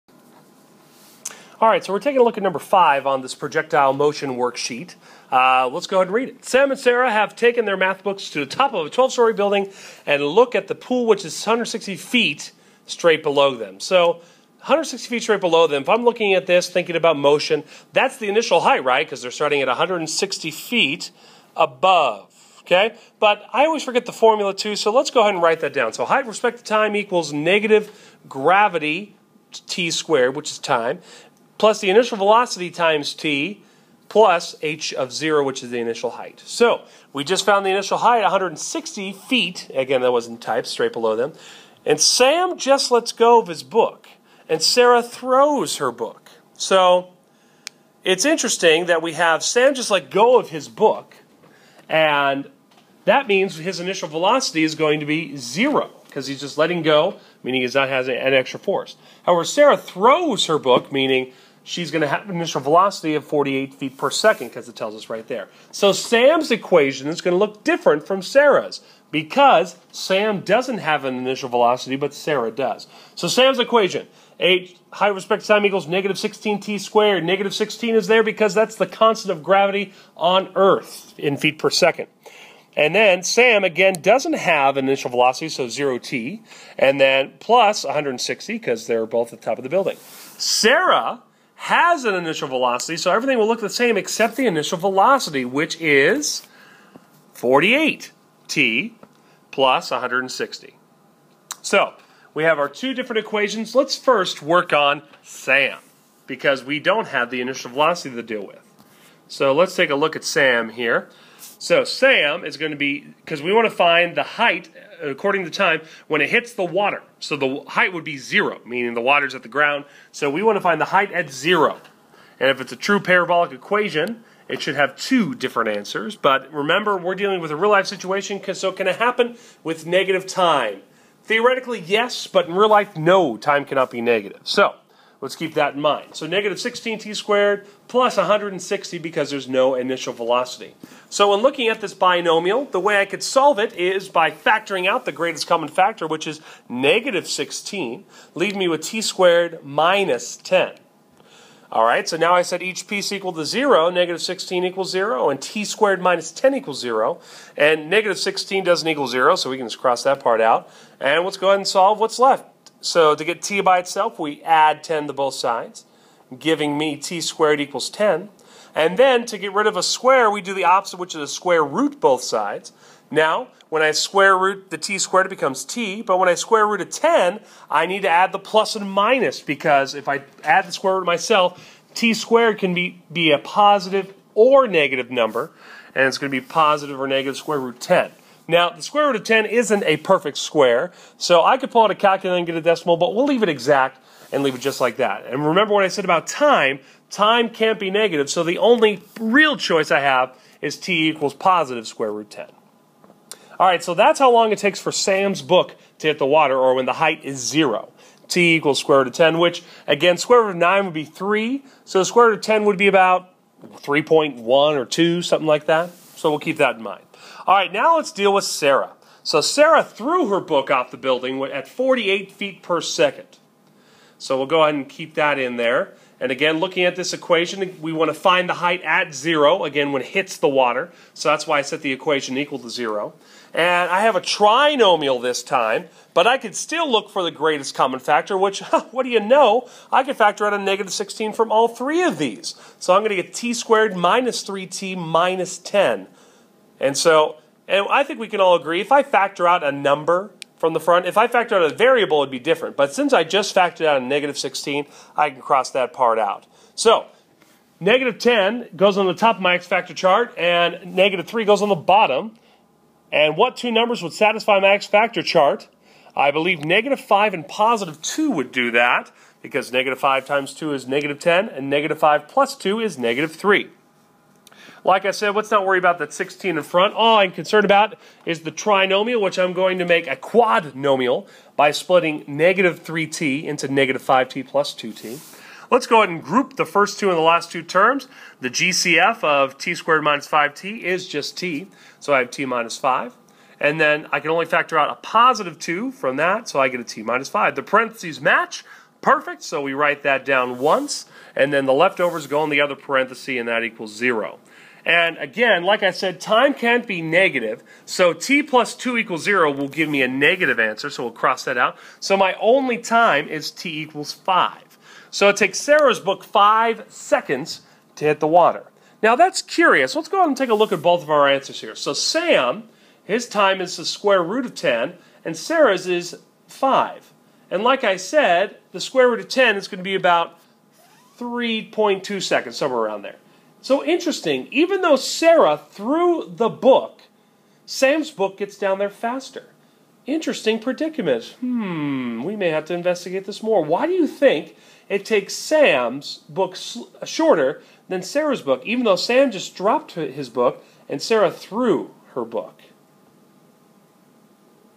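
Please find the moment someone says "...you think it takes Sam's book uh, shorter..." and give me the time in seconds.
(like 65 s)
343 s.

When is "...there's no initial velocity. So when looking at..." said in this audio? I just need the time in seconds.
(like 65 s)
139 s.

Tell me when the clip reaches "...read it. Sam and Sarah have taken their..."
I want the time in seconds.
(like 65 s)
6 s.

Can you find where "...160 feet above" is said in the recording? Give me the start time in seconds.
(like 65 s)
19 s.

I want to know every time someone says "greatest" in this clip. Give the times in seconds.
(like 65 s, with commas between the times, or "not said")
145 s, 237 s.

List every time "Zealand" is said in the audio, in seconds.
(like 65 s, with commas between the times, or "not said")
not said.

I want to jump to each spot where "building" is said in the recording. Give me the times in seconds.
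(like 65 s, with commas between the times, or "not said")
9 s, 89 s, 220 s.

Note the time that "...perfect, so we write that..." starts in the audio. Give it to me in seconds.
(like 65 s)
298 s.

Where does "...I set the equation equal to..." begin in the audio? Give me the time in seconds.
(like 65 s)
231 s.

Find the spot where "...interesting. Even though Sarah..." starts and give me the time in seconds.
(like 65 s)
333 s.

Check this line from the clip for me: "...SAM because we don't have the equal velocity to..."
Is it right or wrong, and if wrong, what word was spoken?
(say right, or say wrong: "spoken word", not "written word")
wrong: "initial", not "equal".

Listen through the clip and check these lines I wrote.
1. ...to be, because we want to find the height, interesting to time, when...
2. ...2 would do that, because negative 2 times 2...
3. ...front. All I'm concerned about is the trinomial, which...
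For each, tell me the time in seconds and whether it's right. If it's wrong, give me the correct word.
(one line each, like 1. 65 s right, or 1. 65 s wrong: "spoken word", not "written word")
1. 112 s wrong: "according", not "interesting"
2. 268 s wrong: "5", not "2"
3. 276 s right.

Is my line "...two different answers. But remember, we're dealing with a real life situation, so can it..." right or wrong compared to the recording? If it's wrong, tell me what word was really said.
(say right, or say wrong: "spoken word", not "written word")
right.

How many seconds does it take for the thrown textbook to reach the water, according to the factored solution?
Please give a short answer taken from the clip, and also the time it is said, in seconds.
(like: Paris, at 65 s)
5 seconds, at 316 s.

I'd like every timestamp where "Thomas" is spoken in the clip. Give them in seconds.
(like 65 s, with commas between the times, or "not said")
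not said.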